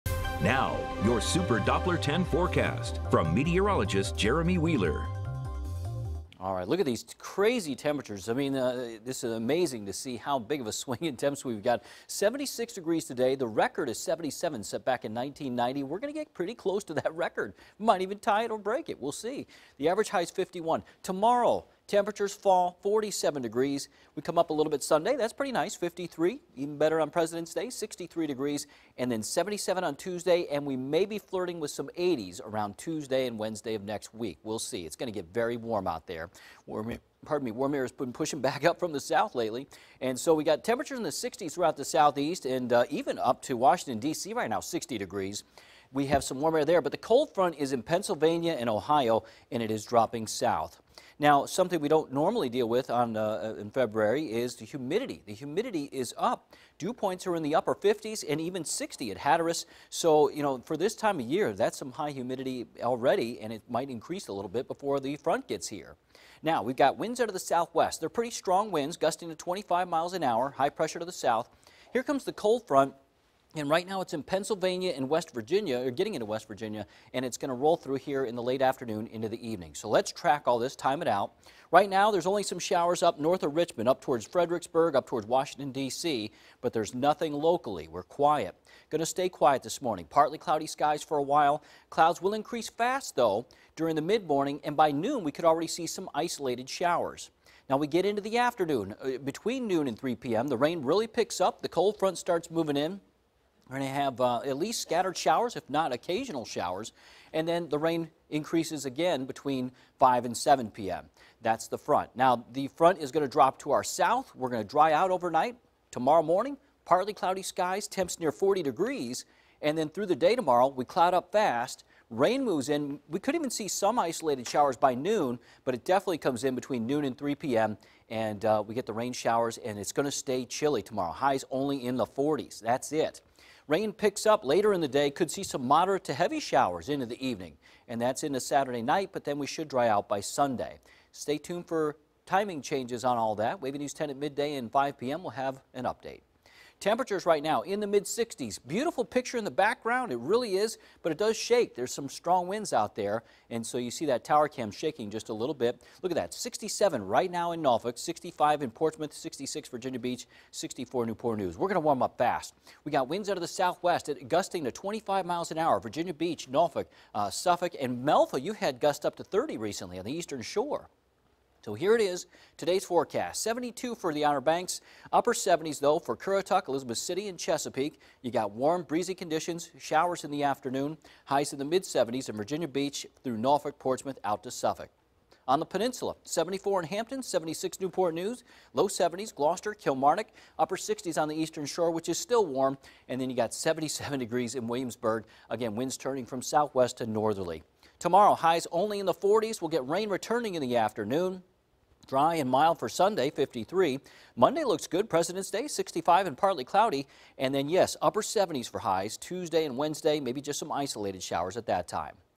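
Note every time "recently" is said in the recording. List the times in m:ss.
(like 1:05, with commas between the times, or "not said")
2:49.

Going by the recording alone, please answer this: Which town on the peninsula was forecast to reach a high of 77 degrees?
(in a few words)
Williamsburg.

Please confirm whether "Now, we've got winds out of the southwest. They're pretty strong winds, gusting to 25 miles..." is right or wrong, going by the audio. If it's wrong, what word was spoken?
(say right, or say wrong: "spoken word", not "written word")
right.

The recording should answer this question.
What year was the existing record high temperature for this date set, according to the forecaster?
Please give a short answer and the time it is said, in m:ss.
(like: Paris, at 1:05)
1990, at 0:15.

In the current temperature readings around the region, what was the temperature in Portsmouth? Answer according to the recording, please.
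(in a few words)
65.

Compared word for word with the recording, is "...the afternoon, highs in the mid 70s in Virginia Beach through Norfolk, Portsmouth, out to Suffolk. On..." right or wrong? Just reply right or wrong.
right.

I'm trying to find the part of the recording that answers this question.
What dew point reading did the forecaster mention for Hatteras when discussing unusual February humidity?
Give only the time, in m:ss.
0:58.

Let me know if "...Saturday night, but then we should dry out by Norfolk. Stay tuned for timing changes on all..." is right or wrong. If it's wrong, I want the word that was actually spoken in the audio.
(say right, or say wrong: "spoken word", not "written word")
wrong: "Sunday", not "Norfolk".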